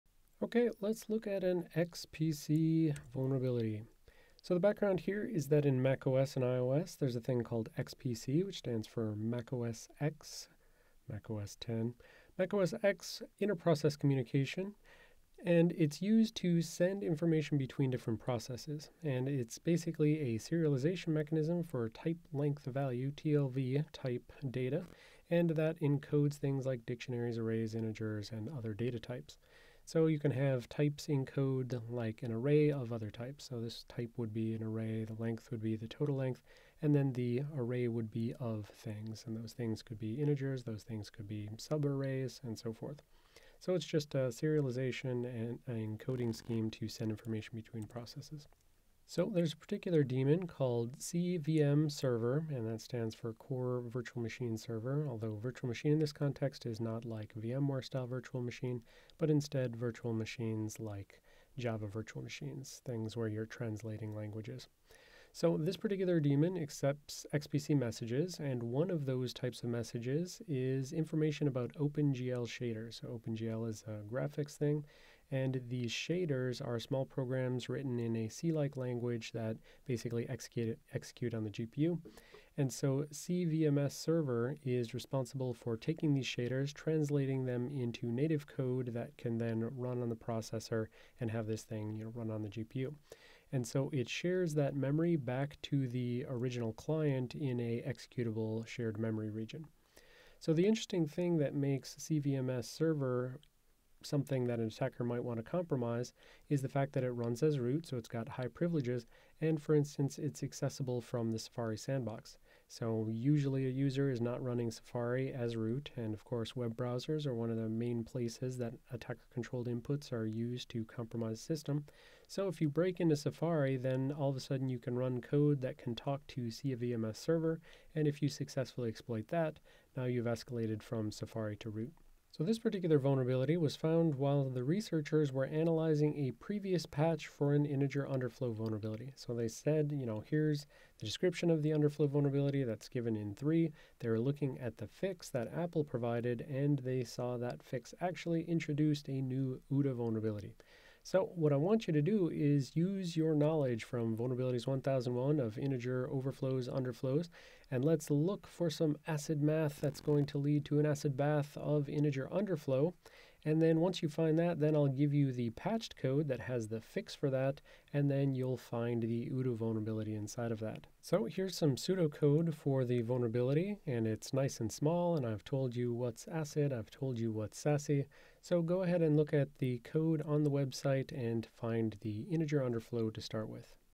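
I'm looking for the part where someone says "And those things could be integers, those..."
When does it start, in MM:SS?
00:39.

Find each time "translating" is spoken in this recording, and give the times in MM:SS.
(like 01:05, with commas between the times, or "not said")
01:03, 01:26.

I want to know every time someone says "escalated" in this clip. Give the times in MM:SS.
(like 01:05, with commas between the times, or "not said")
02:10.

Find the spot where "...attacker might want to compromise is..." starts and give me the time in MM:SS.
01:44.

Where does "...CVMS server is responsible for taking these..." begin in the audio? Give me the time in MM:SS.
01:23.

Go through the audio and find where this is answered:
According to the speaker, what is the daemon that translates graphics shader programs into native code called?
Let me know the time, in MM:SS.
00:53.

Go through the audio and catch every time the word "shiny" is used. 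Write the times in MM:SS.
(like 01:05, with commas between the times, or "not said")
not said.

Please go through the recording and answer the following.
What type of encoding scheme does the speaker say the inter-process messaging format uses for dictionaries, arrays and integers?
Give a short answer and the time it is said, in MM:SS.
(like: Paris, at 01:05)
Type length value (TLV), at 00:21.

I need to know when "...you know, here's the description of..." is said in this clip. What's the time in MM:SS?
02:19.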